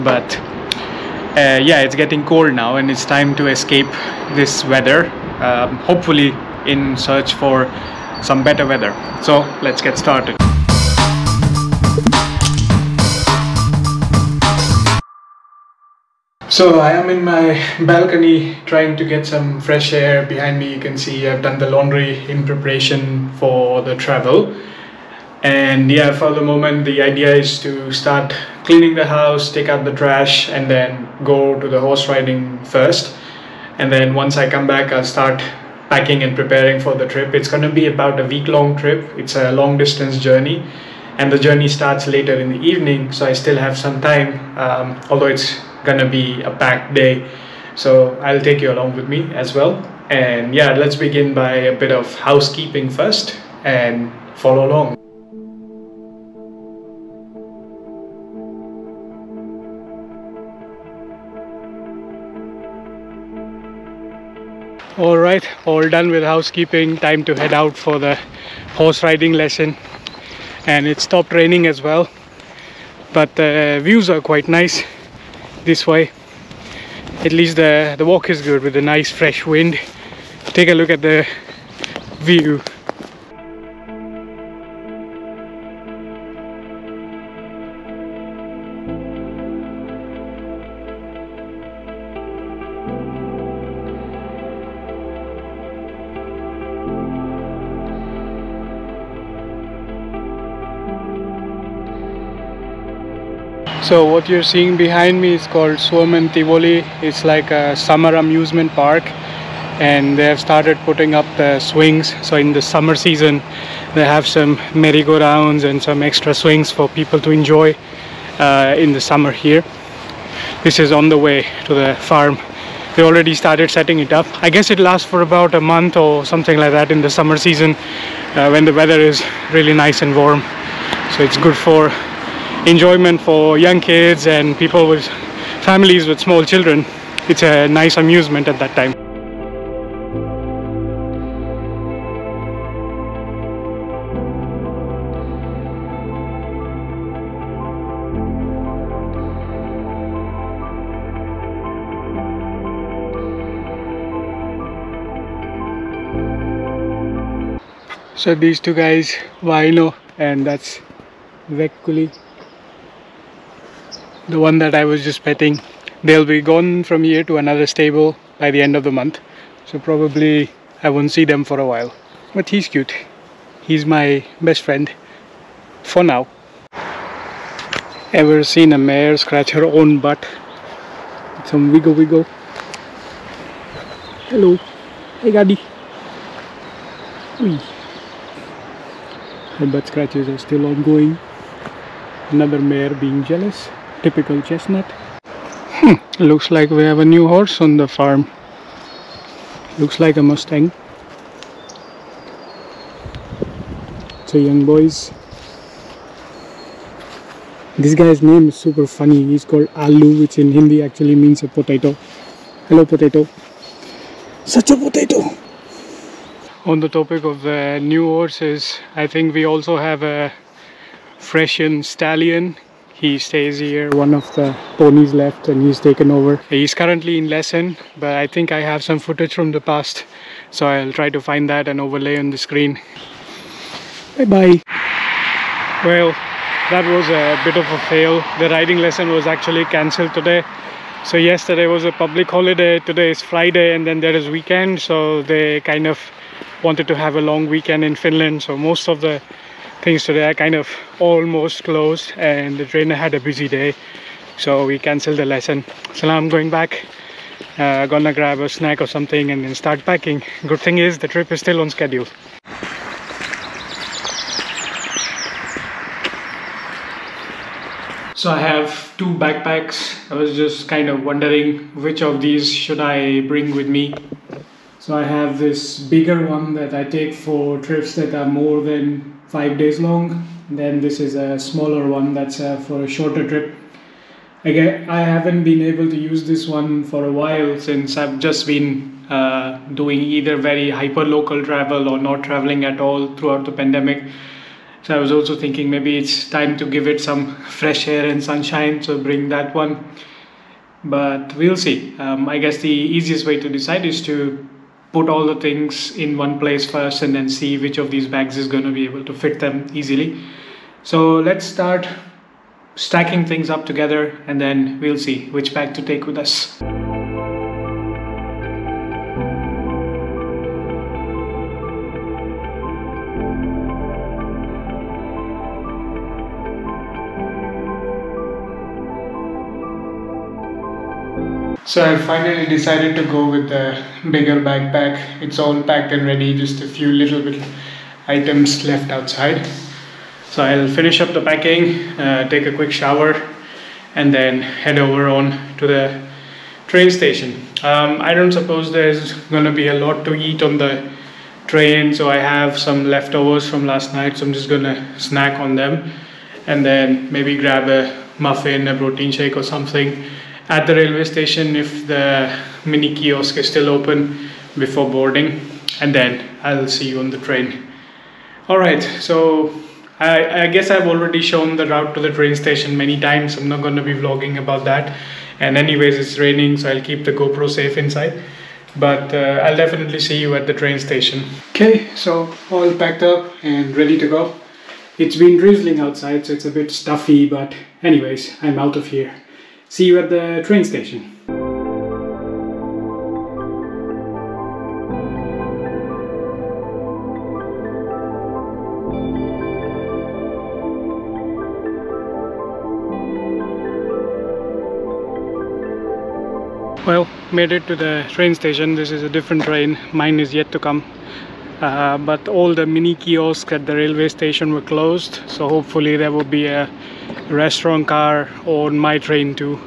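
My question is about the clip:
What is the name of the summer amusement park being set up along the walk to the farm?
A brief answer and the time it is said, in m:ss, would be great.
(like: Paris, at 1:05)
Suomen Tivoli, at 1:45.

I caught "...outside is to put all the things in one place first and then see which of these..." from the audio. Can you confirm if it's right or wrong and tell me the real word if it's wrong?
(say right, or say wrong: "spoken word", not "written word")
wrong: "decide", not "outside".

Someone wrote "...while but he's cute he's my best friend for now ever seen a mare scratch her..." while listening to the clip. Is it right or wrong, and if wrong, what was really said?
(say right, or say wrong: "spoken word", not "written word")
right.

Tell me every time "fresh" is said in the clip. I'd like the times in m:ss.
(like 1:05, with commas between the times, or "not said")
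0:19, 1:19, 4:57.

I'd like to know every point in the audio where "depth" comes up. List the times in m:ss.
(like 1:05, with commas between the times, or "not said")
not said.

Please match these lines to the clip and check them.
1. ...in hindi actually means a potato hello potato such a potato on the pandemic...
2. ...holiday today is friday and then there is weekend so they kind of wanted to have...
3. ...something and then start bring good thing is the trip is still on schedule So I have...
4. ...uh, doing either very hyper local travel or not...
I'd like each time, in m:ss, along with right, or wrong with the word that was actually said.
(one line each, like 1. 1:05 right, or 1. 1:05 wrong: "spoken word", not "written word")
1. 3:30 wrong: "topic", not "pandemic"
2. 4:02 right
3. 4:18 wrong: "packing", not "bring"
4. 4:49 right.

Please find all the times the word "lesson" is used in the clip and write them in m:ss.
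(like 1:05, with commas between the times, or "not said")
1:09, 3:47, 3:58, 4:15.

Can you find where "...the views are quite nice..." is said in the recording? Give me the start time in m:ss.
1:13.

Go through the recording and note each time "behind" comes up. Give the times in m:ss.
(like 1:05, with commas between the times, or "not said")
0:20, 1:44.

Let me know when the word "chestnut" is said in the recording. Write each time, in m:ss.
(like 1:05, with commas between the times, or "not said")
3:14.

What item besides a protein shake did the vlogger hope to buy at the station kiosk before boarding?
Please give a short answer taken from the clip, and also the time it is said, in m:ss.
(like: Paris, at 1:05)
A muffin, at 5:58.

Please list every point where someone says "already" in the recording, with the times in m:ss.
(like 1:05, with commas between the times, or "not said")
2:03, 6:10.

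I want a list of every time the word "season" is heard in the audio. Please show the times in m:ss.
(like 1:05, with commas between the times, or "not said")
1:52, 2:07.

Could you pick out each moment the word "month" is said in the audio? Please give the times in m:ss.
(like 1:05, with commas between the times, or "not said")
2:05, 2:48.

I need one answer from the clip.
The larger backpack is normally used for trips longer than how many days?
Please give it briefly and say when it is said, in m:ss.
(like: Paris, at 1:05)
5, at 4:39.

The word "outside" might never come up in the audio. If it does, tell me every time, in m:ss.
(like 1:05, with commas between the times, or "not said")
5:38, 6:25.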